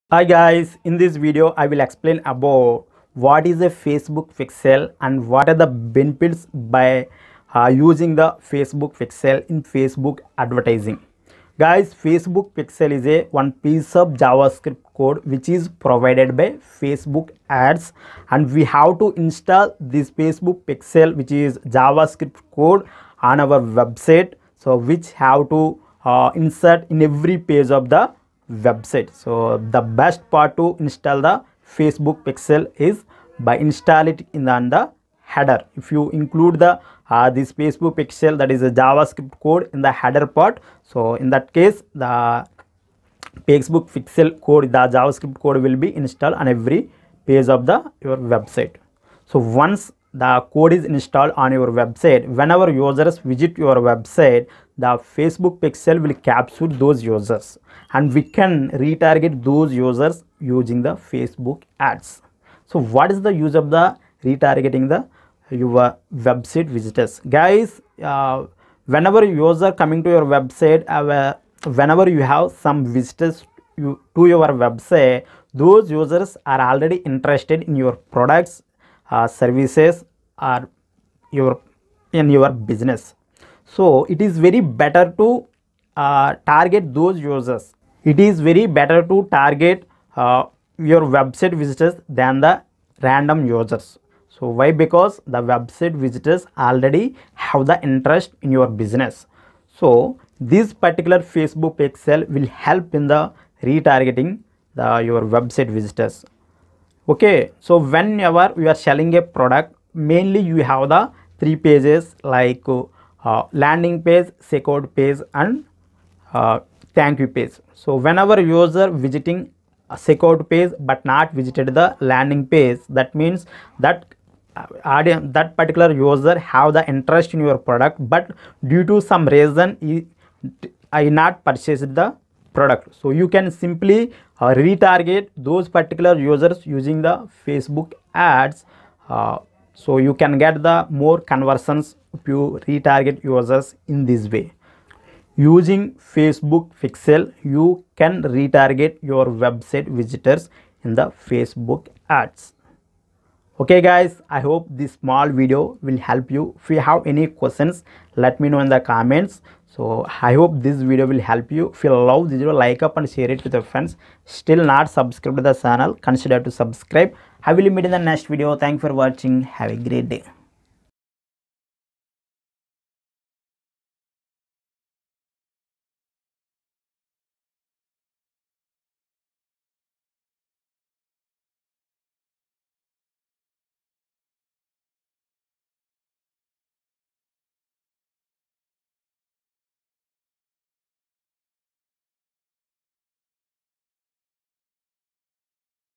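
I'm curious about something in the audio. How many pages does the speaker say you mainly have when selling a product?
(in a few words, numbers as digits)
3.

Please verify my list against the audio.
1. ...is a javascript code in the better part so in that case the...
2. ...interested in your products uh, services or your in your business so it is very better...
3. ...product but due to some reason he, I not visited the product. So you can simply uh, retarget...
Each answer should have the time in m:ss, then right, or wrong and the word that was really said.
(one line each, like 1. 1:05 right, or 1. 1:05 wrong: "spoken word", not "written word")
1. 0:38 wrong: "header", not "better"
2. 1:16 right
3. 2:07 wrong: "purchased", not "visited".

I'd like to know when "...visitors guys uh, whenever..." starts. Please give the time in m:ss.
1:06.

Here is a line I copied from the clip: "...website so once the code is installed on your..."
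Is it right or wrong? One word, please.
right.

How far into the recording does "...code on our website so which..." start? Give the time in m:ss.
0:22.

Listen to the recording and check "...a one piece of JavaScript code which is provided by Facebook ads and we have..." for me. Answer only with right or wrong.
right.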